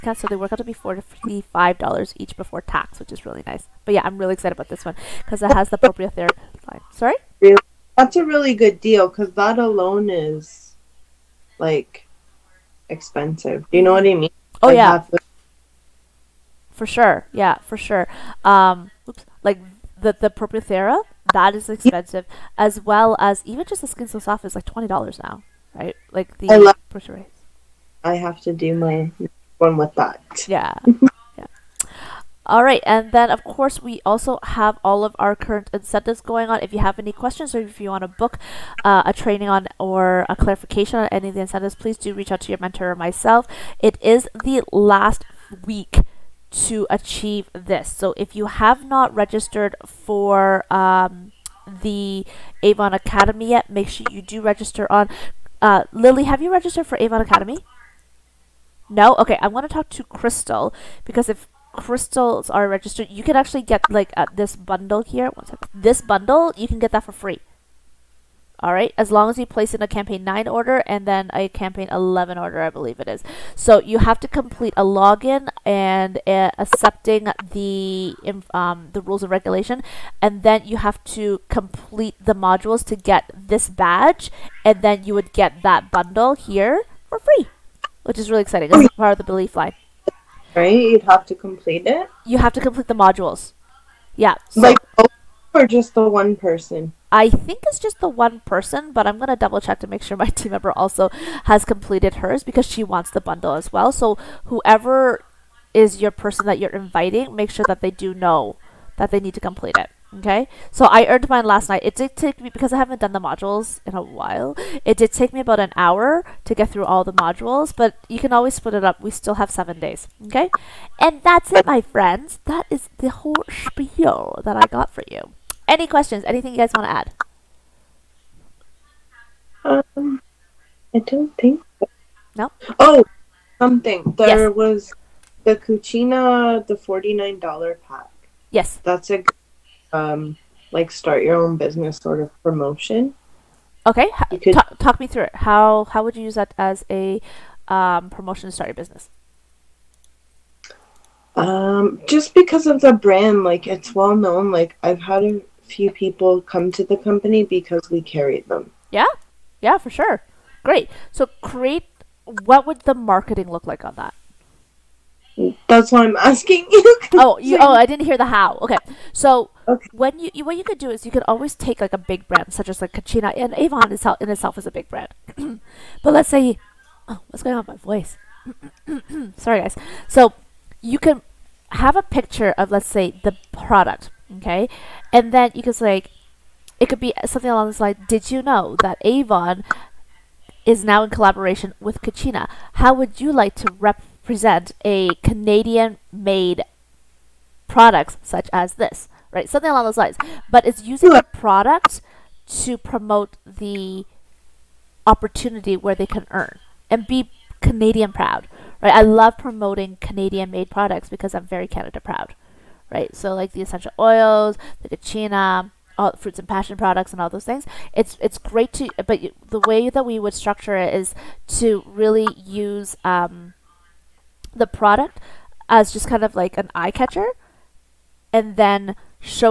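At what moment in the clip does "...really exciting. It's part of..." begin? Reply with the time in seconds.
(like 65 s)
88 s.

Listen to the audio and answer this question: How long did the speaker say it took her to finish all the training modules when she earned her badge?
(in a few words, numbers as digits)
about an hour.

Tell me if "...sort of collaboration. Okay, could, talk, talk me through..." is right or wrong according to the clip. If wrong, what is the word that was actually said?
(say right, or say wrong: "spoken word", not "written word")
wrong: "promotion", not "collaboration".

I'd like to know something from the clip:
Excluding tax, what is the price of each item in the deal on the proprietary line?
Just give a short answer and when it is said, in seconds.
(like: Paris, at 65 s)
$45, at 0 s.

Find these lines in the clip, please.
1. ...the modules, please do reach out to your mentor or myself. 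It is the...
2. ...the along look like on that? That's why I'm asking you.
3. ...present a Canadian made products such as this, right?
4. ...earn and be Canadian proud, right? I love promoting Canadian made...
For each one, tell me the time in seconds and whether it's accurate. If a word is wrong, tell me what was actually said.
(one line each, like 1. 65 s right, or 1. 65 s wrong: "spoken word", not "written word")
1. 41 s wrong: "incentives", not "modules"
2. 162 s wrong: "marketing", not "along"
3. 194 s right
4. 206 s right.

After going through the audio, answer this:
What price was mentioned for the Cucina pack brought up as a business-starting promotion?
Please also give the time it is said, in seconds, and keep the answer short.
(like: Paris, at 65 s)
$49, at 136 s.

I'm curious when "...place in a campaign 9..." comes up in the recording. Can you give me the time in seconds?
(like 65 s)
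69 s.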